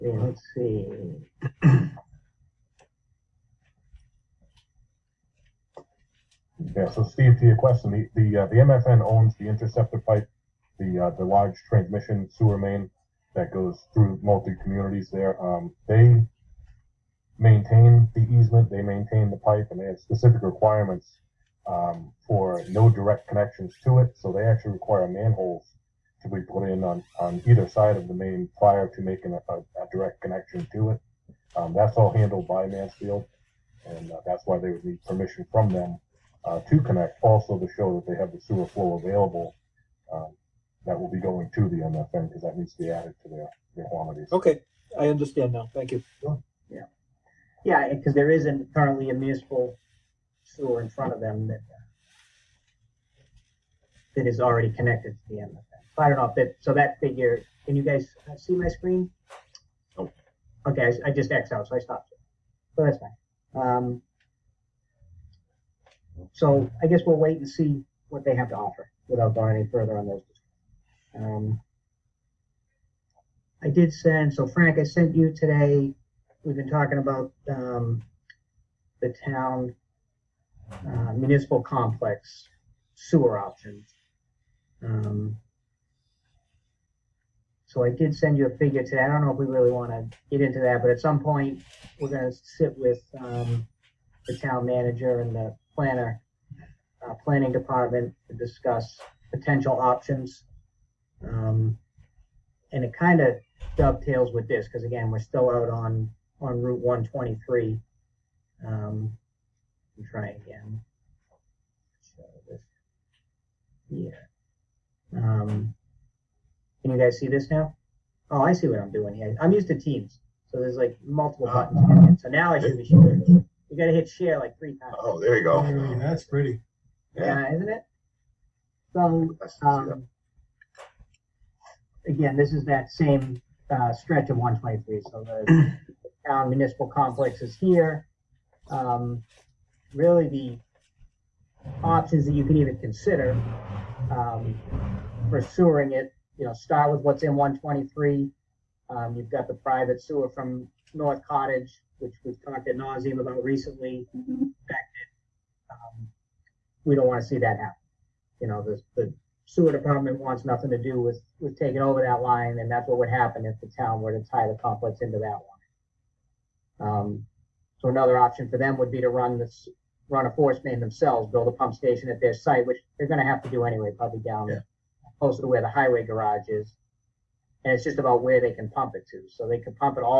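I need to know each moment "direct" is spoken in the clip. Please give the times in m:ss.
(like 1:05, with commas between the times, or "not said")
0:22, 0:29.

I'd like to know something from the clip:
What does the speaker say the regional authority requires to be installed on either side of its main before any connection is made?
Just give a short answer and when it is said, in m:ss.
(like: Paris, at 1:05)
manholes, at 0:25.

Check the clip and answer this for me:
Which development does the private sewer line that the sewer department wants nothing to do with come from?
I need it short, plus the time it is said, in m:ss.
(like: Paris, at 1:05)
North Cottage, at 2:30.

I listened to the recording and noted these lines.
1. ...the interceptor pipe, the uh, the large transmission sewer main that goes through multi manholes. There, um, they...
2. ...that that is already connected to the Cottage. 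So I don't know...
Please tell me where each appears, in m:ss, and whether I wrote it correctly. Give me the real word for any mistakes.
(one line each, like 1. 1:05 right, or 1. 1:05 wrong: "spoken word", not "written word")
1. 0:09 wrong: "communities", not "manholes"
2. 0:51 wrong: "MFN", not "Cottage".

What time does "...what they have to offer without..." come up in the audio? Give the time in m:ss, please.
1:08.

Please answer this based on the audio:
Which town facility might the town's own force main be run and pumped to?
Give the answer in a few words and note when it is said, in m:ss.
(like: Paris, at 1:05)
highway garage, at 2:55.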